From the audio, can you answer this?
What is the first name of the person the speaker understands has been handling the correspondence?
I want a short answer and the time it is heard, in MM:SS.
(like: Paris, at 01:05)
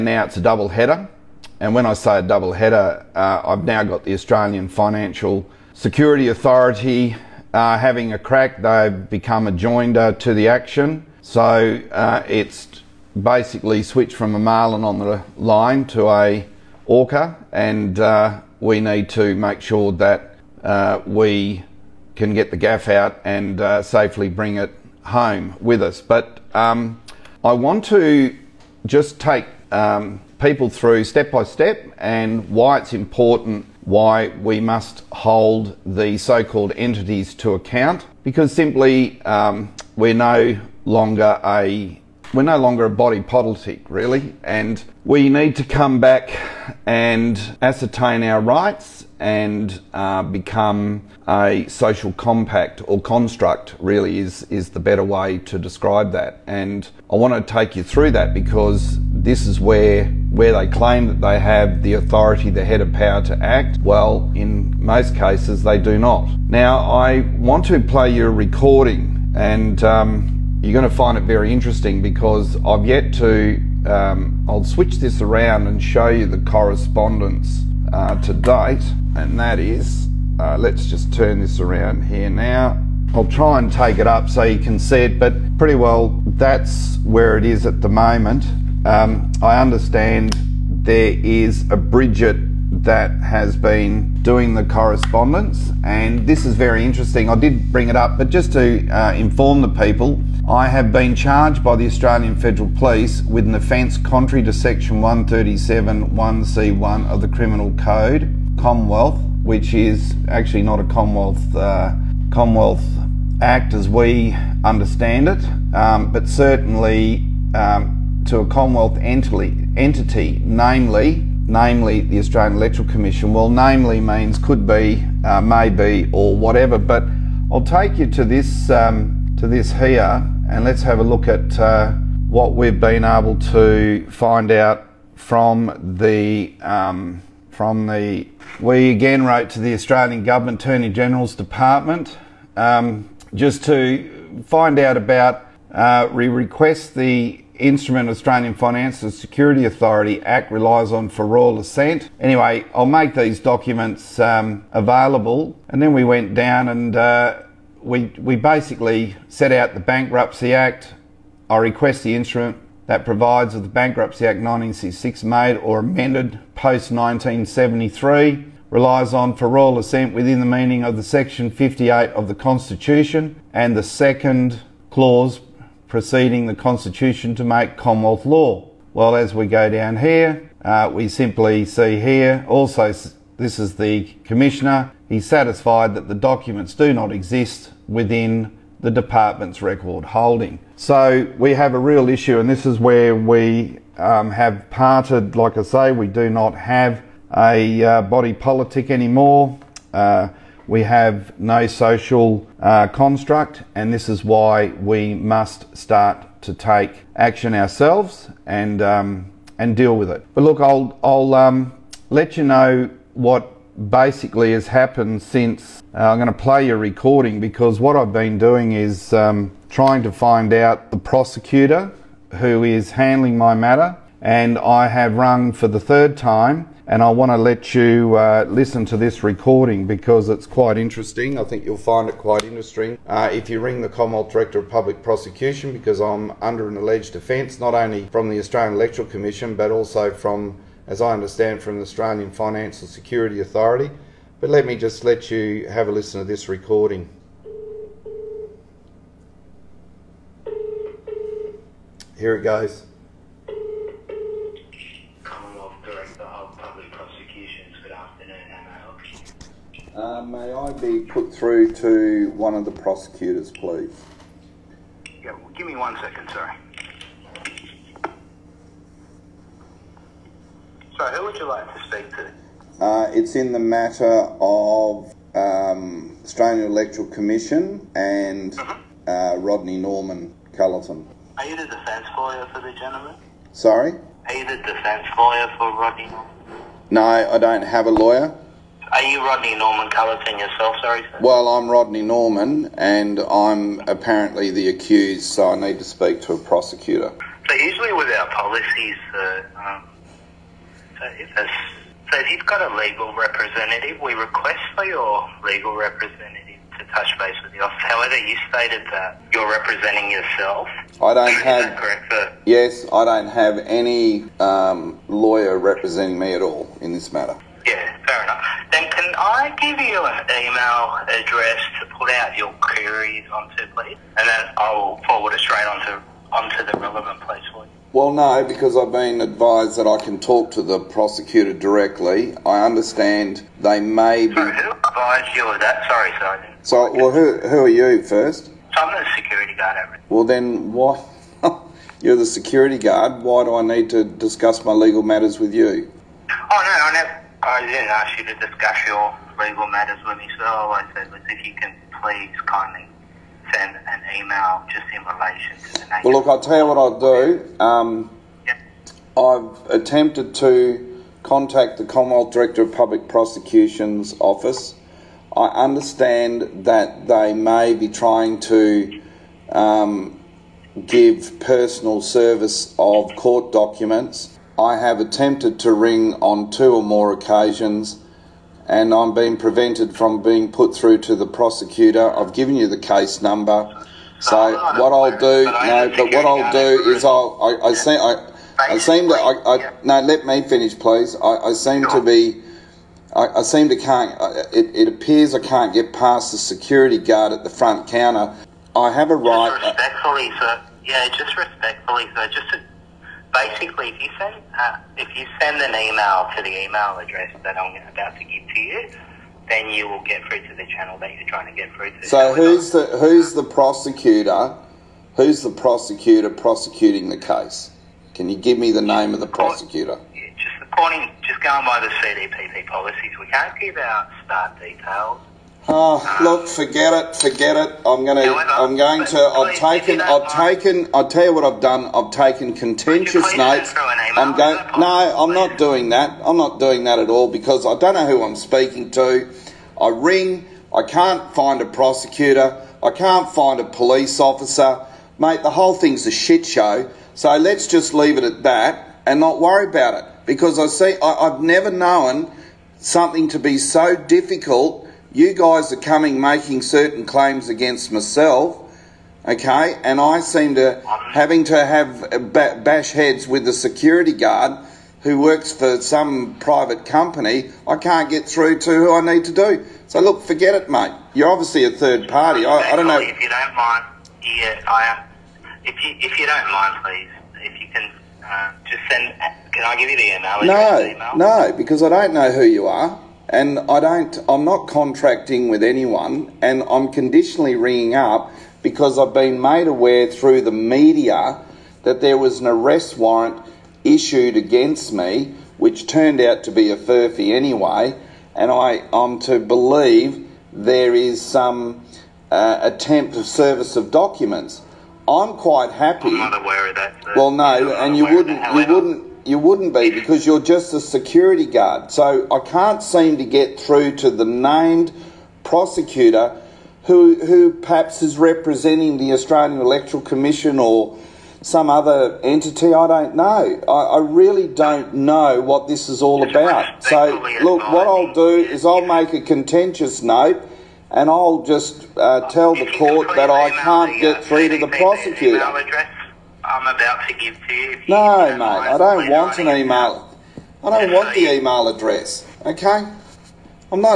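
Bridget, at 01:31.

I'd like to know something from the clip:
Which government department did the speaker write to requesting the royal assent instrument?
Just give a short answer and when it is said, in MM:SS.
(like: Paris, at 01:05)
Attorney General's Department, at 02:20.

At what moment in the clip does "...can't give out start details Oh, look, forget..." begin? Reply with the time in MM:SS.
07:03.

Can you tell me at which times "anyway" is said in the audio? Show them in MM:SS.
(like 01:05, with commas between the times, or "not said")
02:32, 08:17.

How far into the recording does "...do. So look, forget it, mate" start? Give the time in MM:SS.
07:49.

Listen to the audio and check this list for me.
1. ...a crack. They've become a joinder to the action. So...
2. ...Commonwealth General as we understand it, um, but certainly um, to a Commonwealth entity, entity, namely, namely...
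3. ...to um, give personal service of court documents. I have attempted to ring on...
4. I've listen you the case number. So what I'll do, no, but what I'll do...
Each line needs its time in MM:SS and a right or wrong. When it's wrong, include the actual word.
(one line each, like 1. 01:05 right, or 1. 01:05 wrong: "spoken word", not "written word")
1. 00:08 right
2. 01:52 wrong: "Act", not "General"
3. 06:08 right
4. 06:22 wrong: "given", not "listen".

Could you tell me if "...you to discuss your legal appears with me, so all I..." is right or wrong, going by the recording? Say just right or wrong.
wrong.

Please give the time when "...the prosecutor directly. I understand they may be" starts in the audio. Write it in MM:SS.
05:30.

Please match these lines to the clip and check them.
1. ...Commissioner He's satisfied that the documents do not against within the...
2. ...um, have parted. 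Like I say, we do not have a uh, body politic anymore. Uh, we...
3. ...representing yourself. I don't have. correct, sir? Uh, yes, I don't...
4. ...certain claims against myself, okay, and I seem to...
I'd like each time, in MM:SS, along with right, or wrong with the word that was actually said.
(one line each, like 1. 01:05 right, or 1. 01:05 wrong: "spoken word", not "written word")
1. 03:04 wrong: "exist", not "against"
2. 03:13 right
3. 05:09 right
4. 07:36 right.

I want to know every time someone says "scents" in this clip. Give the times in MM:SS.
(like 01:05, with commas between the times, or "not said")
not said.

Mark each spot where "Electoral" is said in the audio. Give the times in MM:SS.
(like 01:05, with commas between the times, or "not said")
02:02, 03:58, 04:36, 08:39.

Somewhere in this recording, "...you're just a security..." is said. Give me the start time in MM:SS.
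08:30.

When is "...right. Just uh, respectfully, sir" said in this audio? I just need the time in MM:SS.
06:39.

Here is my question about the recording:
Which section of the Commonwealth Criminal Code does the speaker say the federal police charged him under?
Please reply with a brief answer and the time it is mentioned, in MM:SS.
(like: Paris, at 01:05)
137.1(c)(1), at 01:44.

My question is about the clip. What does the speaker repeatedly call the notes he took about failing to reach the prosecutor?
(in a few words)
contentious notes.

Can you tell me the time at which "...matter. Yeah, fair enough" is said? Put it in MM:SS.
05:17.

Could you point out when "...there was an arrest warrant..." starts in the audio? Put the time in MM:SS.
08:12.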